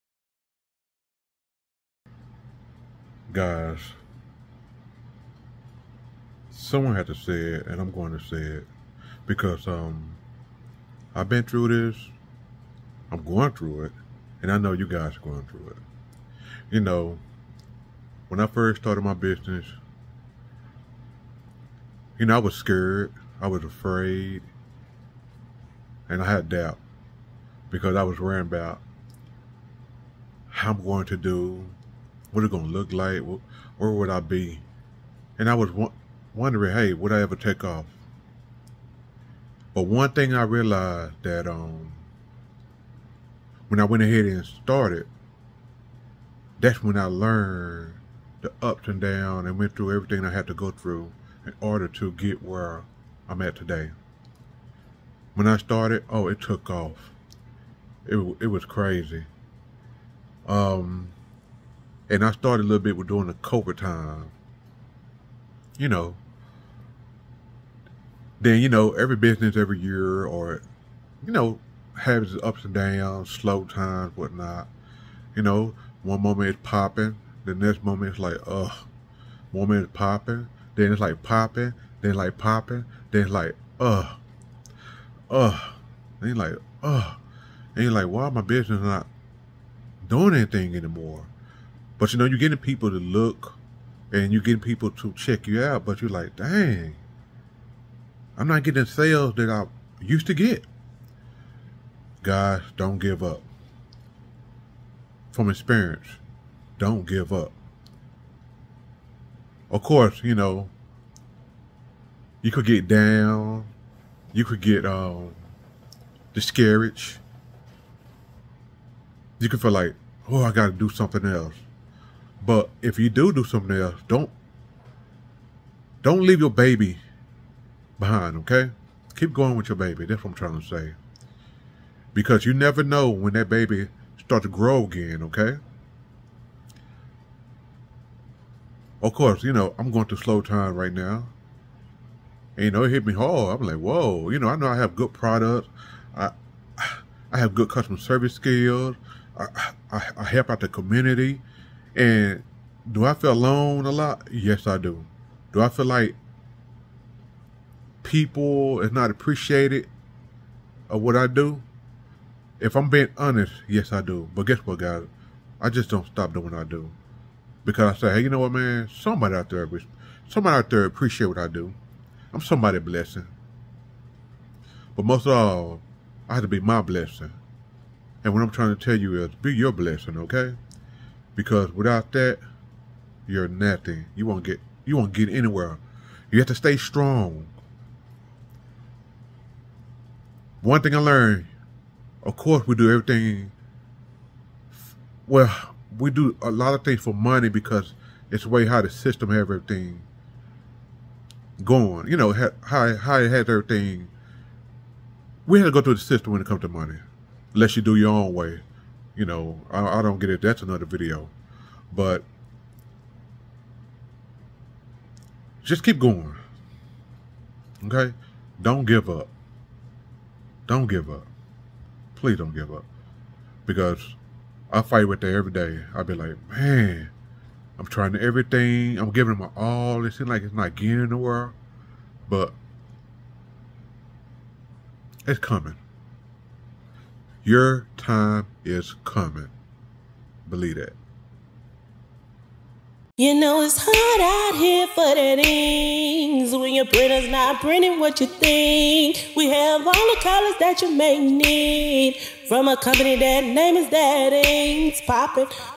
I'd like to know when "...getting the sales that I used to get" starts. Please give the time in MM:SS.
01:38.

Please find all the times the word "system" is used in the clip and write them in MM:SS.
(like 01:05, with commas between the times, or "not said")
03:18, 03:26.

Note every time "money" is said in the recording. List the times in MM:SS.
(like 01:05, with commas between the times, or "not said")
03:17, 03:26.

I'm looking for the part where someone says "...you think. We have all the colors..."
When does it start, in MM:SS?
04:08.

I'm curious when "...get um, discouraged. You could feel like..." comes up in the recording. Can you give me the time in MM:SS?
01:54.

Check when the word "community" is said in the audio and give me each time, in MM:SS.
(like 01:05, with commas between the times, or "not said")
02:30.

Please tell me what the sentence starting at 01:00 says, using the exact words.
Um, and I started a little bit with doing the cobra time.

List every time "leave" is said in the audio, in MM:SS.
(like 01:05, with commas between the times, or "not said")
02:06.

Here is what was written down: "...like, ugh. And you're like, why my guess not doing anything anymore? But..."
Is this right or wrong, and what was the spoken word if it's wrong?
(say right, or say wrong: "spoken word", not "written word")
wrong: "business", not "guess".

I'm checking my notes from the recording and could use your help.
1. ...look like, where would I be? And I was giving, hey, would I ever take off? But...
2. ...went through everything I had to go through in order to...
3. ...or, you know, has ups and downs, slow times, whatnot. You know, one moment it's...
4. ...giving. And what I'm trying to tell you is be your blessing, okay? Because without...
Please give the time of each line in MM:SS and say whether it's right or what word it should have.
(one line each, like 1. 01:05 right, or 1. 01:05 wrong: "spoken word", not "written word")
1. 00:32 wrong: "wondering", not "giving"
2. 00:49 right
3. 01:10 right
4. 02:56 wrong: "blessing", not "giving".